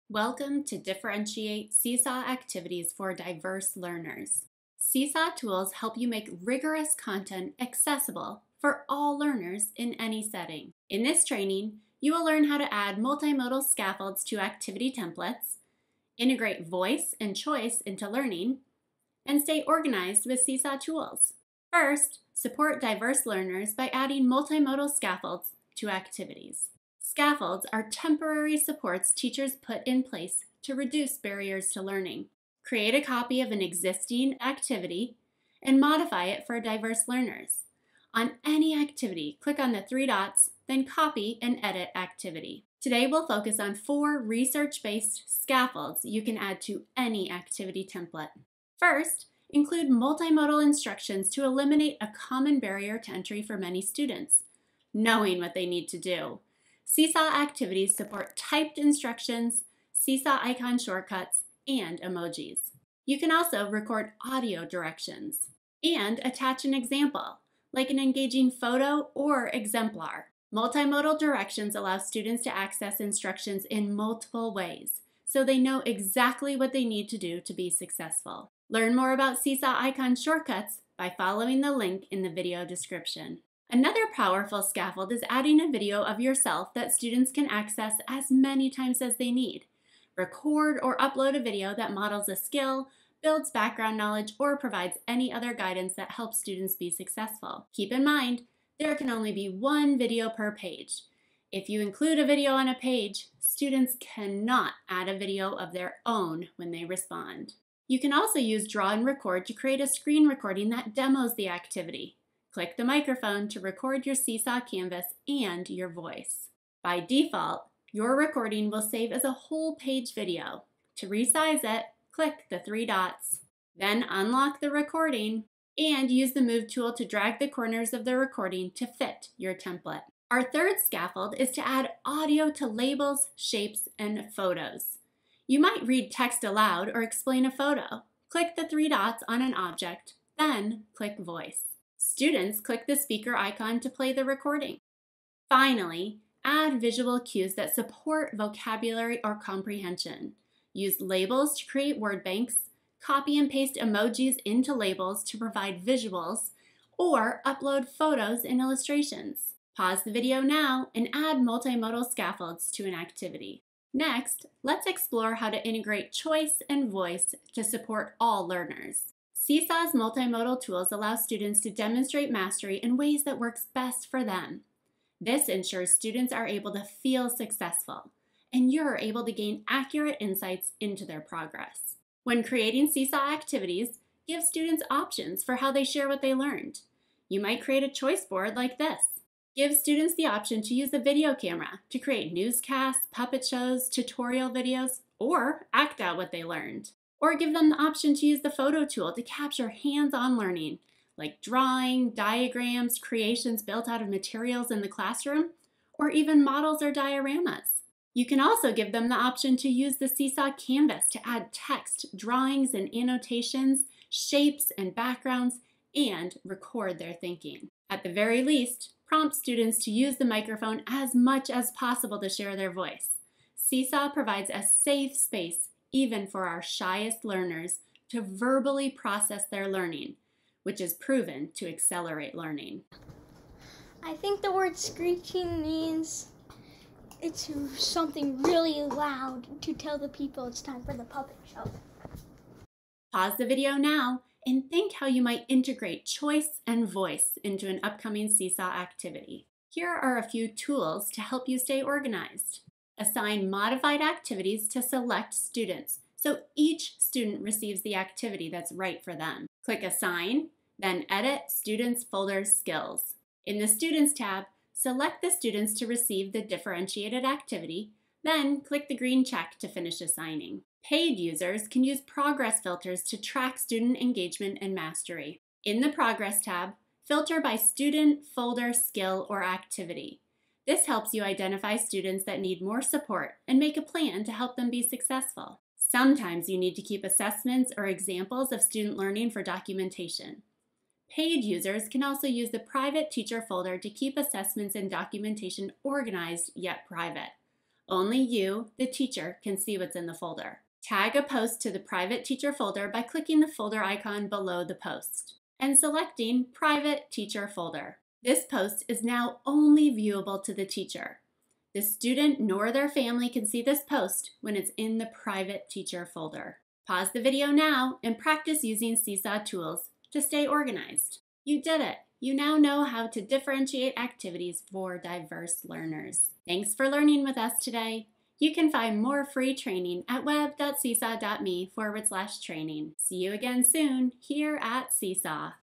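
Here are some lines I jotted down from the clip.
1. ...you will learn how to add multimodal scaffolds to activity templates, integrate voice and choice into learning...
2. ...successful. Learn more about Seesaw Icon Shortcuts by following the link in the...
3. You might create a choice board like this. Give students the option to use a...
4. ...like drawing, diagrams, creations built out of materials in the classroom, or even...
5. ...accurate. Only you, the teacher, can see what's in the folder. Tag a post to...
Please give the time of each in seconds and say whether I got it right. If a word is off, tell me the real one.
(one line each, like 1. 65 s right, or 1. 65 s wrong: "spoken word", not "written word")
1. 12 s right
2. 77 s right
3. 187 s right
4. 201 s right
5. 296 s wrong: "private", not "accurate".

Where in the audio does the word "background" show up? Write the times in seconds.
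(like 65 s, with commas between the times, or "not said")
93 s, 214 s.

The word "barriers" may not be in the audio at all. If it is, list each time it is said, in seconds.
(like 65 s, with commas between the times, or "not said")
31 s, 52 s.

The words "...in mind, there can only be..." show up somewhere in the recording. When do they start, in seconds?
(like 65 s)
97 s.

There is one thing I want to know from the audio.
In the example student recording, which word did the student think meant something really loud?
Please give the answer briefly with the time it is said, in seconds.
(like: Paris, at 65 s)
screeching, at 234 s.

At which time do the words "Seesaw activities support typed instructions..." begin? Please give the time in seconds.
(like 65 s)
56 s.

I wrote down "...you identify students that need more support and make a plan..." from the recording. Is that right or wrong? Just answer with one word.
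right.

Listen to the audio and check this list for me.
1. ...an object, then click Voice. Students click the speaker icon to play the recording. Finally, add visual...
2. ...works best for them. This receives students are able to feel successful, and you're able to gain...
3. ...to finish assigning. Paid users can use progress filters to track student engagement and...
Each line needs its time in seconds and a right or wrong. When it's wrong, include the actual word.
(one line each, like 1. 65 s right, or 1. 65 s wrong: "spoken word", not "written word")
1. 139 s right
2. 173 s wrong: "ensures", not "receives"
3. 269 s right.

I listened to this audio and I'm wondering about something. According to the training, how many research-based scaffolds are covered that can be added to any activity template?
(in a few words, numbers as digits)
4.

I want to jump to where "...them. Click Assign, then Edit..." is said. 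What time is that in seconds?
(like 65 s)
259 s.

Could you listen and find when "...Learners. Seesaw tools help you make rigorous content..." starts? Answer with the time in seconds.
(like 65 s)
3 s.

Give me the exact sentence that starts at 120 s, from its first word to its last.
To resize it, click the three dots.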